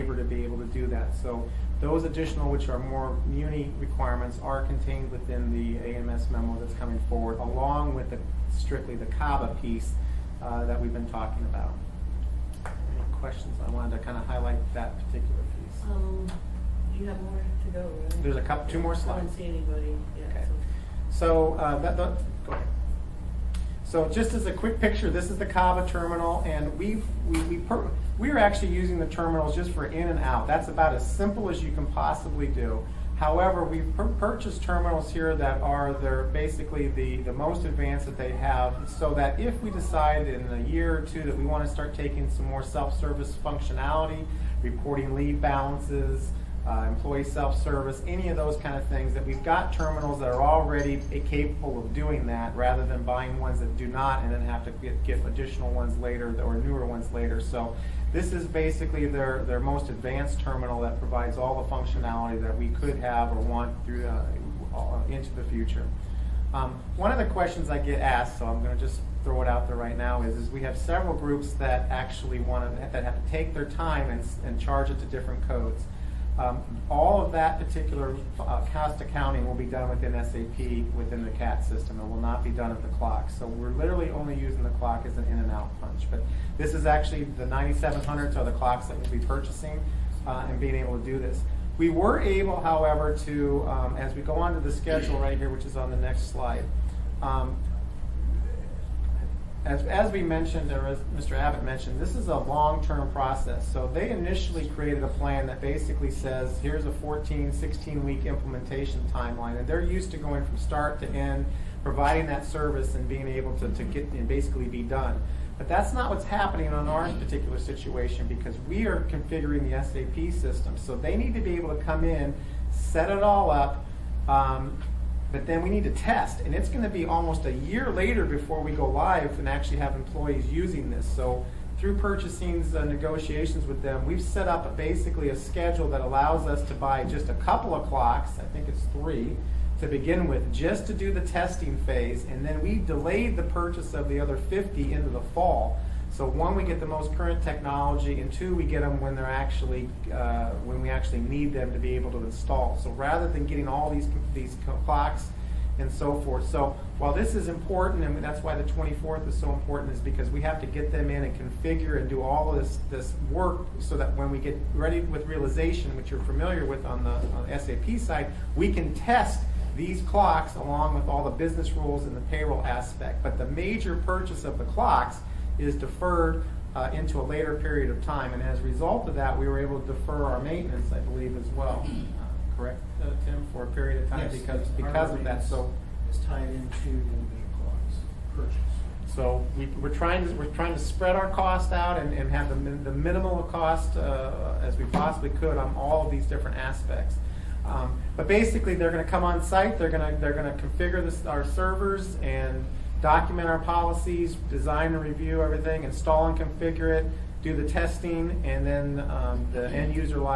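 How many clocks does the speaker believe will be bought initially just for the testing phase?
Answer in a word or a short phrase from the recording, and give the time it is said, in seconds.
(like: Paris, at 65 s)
3, at 138 s.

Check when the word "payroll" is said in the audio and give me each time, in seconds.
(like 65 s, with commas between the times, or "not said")
172 s.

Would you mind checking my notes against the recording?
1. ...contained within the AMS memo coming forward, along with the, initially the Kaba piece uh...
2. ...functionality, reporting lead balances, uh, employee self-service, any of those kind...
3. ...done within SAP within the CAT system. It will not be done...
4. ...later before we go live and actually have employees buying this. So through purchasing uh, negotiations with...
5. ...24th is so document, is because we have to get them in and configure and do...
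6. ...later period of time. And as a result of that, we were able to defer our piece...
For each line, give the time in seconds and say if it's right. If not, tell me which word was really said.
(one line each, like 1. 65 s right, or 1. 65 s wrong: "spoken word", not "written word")
1. 4 s wrong: "strictly", not "initially"
2. 43 s right
3. 79 s right
4. 127 s wrong: "using", not "buying"
5. 158 s wrong: "important", not "document"
6. 177 s wrong: "maintenance", not "piece".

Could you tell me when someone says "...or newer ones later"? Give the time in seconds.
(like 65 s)
56 s.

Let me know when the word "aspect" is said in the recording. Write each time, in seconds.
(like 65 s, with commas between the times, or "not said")
172 s, 196 s.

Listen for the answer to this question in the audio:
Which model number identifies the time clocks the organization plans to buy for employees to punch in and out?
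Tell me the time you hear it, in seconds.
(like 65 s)
87 s.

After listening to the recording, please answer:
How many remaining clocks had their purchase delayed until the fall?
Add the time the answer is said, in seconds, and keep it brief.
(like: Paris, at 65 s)
50, at 144 s.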